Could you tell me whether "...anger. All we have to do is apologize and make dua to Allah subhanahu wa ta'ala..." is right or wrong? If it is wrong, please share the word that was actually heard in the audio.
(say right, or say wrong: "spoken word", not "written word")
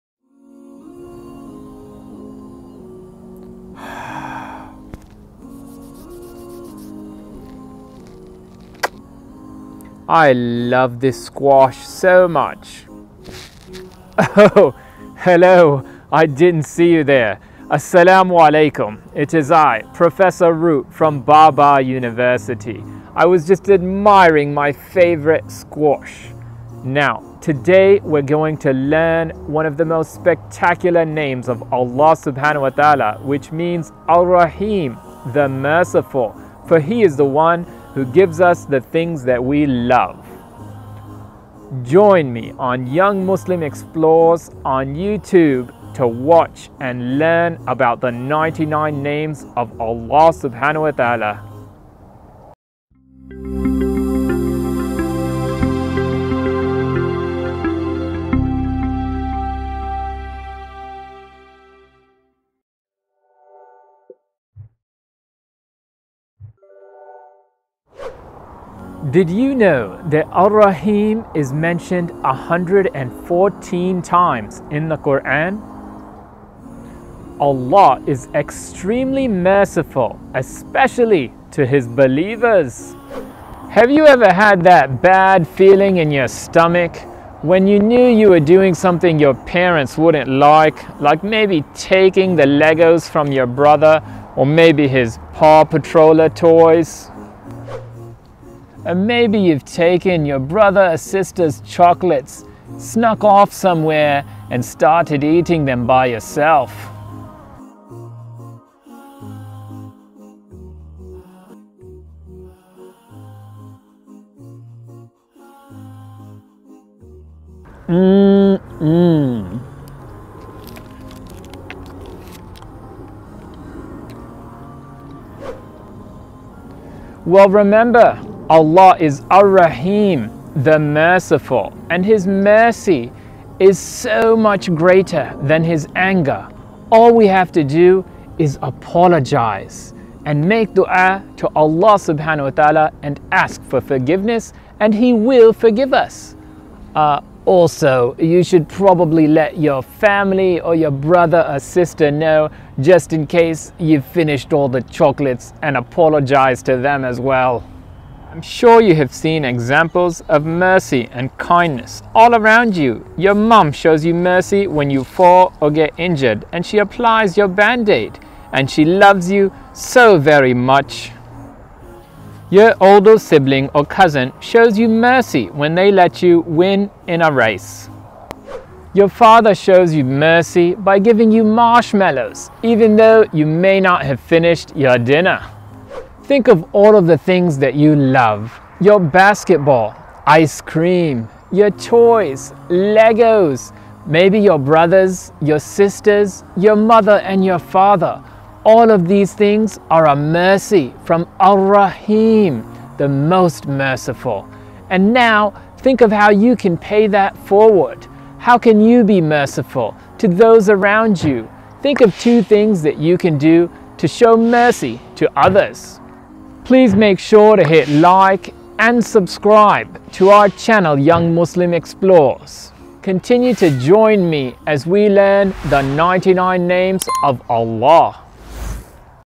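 right.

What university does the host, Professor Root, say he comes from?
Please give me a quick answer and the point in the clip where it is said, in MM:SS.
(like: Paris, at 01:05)
Baba University, at 00:21.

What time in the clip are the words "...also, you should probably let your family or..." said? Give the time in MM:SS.
02:27.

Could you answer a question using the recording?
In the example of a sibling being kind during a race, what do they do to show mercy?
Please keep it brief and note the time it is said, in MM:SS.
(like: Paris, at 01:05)
Let you win, at 02:55.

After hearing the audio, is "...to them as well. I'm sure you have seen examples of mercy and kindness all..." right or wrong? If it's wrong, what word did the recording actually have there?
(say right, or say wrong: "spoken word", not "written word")
right.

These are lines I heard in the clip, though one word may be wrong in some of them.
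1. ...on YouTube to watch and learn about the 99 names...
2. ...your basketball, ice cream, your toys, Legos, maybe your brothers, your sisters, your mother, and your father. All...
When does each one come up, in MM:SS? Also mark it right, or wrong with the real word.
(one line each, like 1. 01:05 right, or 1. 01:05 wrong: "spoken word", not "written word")
1. 00:44 right
2. 03:08 right.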